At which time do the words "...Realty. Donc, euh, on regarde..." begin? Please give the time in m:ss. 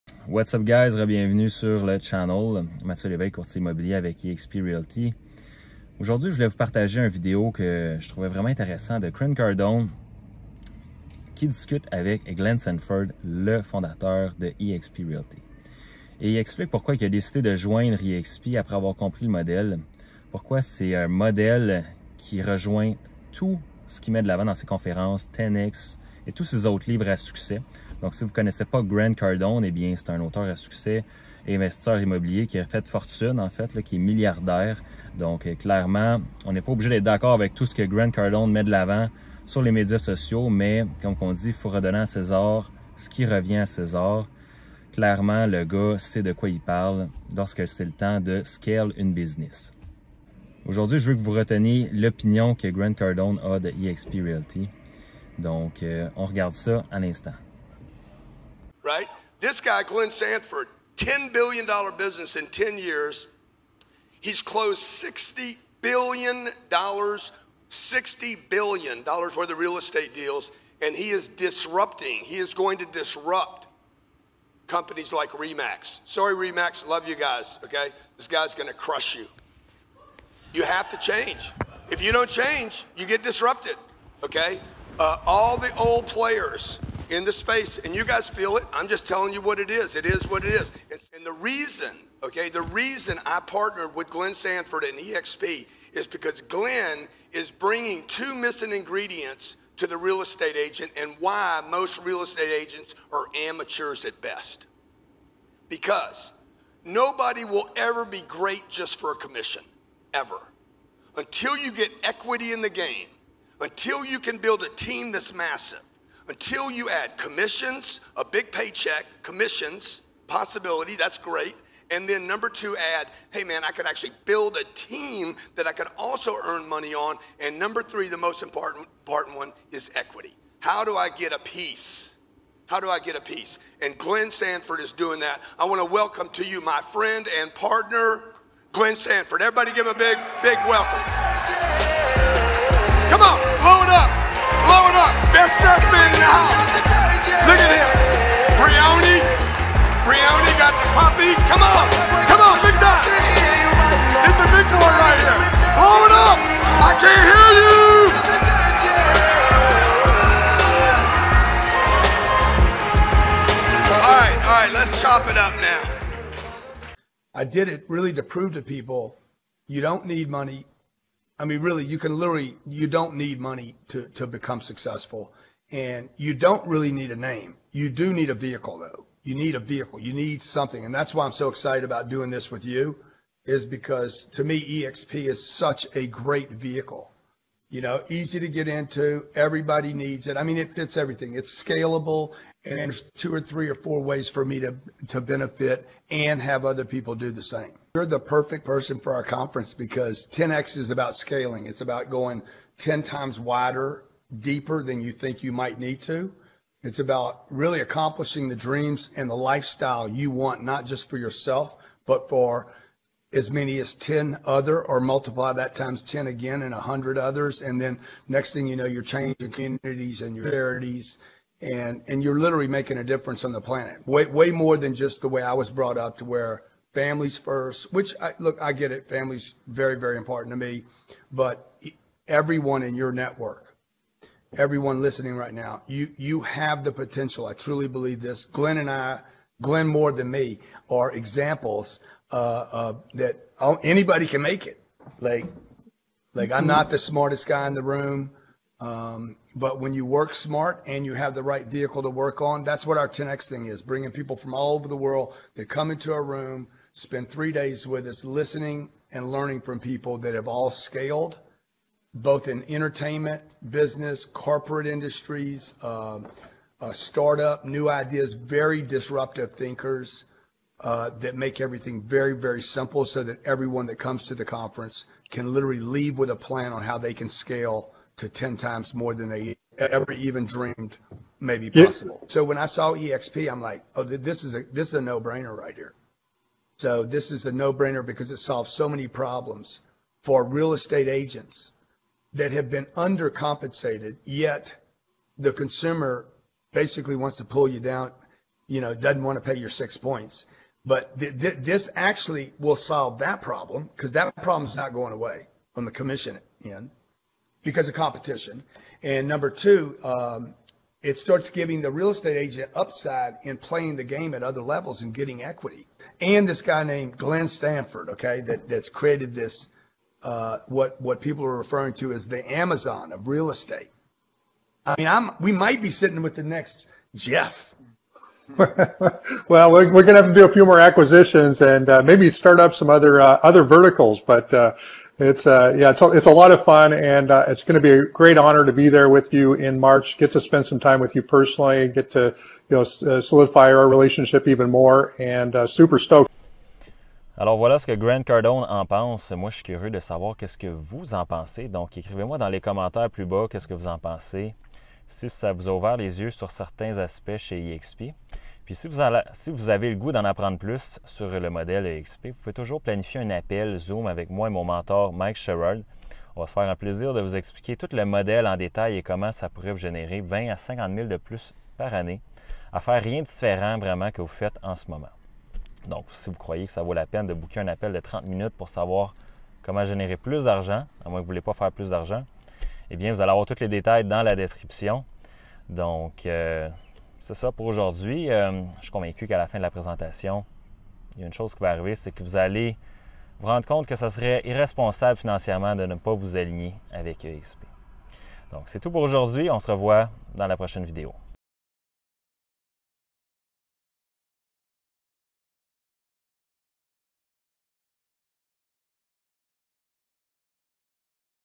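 0:54.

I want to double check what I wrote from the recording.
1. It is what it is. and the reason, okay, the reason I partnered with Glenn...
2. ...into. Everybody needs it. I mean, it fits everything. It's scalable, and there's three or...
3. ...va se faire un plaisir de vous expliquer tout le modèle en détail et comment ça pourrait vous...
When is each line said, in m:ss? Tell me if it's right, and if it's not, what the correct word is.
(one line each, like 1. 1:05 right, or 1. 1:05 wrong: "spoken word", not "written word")
1. 1:29 right
2. 3:08 wrong: "two", not "three"
3. 6:06 right.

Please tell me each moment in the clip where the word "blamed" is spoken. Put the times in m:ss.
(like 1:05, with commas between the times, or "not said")
not said.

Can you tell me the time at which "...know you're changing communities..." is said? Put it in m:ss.
3:38.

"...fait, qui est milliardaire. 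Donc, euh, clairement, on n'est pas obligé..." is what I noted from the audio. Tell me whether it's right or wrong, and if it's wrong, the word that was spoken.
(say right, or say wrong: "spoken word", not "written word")
right.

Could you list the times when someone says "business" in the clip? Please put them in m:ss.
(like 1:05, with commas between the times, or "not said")
0:49, 1:01, 4:23.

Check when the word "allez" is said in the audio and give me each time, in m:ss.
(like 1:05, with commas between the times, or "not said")
6:23, 6:32.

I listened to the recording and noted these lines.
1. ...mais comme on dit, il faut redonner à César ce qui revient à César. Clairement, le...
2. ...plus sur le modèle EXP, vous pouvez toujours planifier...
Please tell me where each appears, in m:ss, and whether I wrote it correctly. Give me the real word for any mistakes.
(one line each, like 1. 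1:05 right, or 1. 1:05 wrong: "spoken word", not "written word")
1. 0:40 right
2. 6:00 right.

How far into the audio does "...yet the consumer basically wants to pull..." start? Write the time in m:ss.
4:54.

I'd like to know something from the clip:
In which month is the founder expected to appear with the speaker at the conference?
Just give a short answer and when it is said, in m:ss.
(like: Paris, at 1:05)
March, at 5:39.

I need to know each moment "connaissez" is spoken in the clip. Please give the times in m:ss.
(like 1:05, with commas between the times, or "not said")
0:28.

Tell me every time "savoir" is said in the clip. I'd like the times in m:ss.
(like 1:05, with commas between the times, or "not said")
5:49, 6:18.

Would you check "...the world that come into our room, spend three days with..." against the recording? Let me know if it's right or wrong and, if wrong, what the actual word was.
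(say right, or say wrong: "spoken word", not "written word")
right.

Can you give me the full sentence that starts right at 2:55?
And you don't really need a name.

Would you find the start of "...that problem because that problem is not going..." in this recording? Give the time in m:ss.
5:03.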